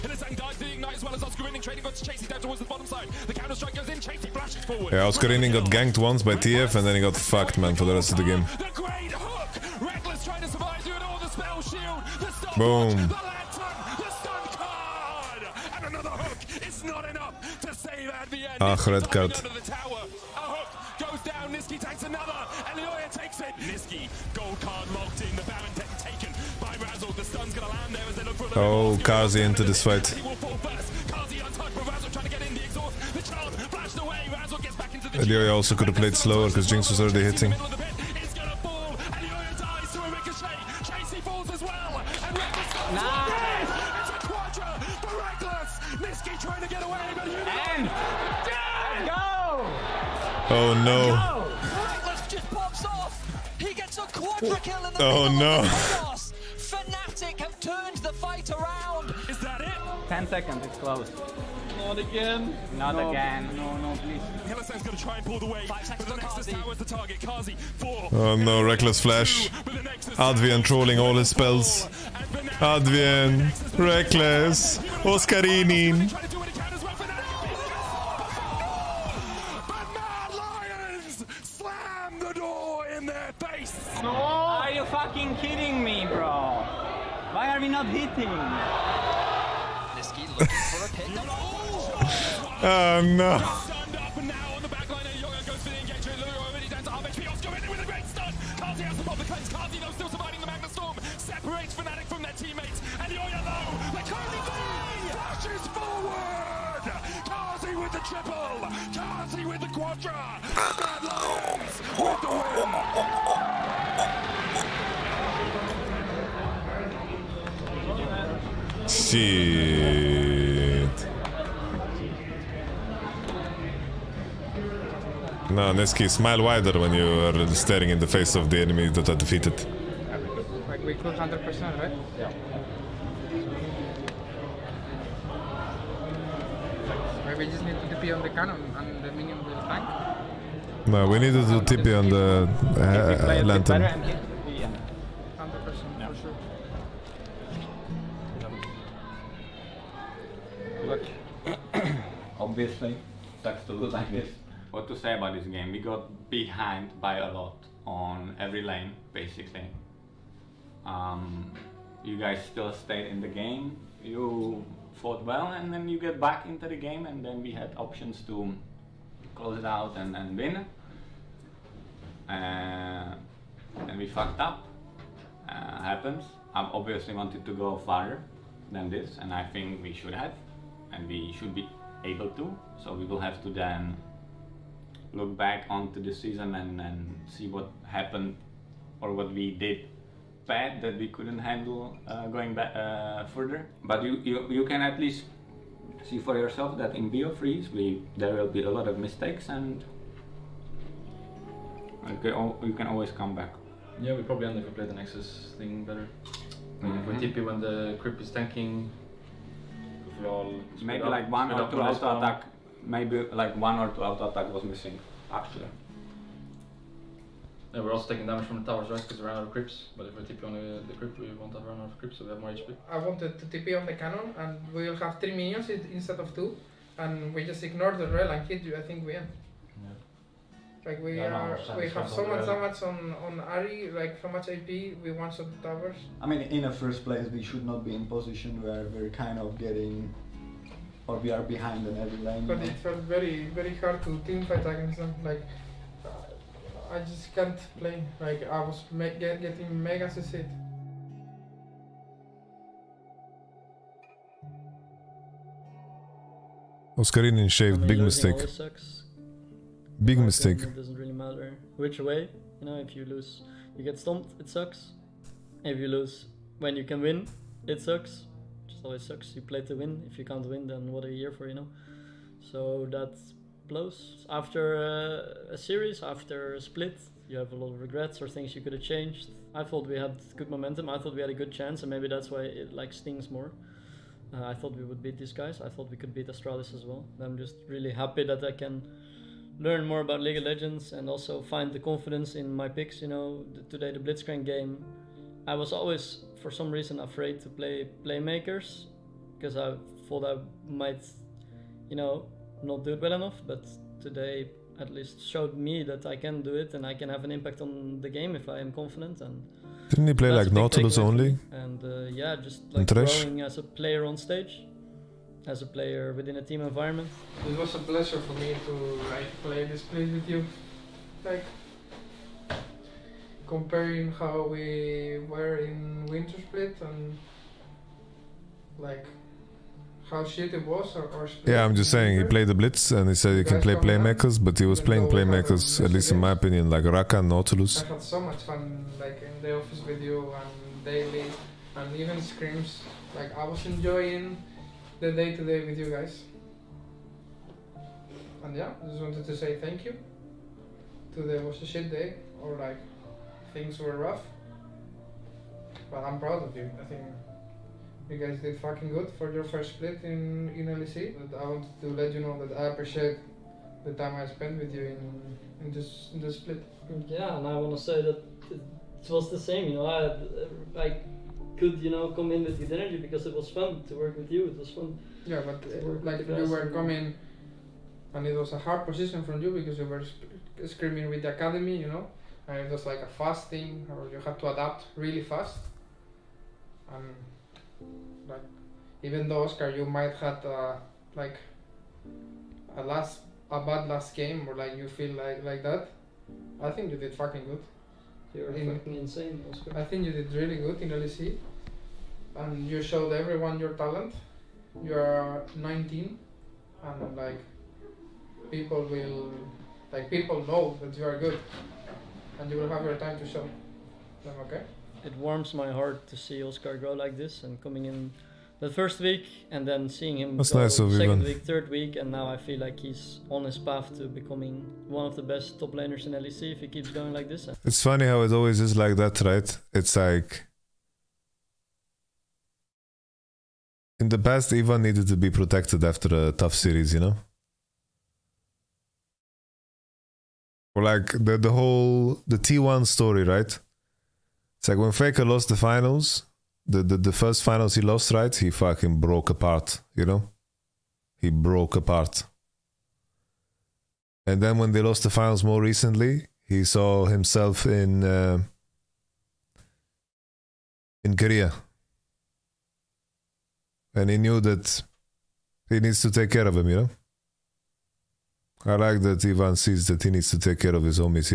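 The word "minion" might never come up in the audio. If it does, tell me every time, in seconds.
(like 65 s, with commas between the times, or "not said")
139 s, 225 s.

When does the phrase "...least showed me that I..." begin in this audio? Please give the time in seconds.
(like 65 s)
304 s.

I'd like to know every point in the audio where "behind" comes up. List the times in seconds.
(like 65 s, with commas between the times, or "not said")
156 s, 241 s.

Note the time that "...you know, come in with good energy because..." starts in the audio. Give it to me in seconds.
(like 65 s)
371 s.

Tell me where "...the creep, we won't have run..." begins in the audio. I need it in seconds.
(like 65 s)
220 s.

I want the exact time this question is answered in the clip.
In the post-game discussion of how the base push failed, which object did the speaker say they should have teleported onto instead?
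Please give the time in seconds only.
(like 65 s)
143 s.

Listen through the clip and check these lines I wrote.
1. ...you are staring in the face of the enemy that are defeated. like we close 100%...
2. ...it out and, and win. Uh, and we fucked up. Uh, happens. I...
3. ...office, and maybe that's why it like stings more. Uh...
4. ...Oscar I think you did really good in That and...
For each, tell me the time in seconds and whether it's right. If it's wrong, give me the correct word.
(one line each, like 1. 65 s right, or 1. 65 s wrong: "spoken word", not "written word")
1. 126 s right
2. 169 s right
3. 281 s wrong: "chance", not "office"
4. 399 s wrong: "LEC", not "That".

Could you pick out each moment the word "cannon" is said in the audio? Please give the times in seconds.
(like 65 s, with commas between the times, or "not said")
138 s, 223 s.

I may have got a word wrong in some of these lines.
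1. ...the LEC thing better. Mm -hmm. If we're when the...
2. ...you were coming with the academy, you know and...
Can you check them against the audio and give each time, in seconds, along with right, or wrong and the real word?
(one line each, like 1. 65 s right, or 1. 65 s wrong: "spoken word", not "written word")
1. 204 s wrong: "Nexus", not "LEC"
2. 379 s wrong: "screaming", not "coming".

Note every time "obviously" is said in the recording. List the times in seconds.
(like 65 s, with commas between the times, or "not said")
152 s, 176 s.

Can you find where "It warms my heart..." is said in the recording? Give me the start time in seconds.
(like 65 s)
415 s.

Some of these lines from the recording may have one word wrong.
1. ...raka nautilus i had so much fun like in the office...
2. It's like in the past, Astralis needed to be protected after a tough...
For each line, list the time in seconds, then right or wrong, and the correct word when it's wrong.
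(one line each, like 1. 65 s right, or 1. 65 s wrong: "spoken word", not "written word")
1. 336 s right
2. 429 s wrong: "Ivan", not "Astralis".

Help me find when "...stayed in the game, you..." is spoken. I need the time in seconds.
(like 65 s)
162 s.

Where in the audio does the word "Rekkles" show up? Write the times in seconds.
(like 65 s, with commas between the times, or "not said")
68 s, 73 s.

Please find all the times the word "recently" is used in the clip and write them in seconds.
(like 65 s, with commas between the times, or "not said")
455 s.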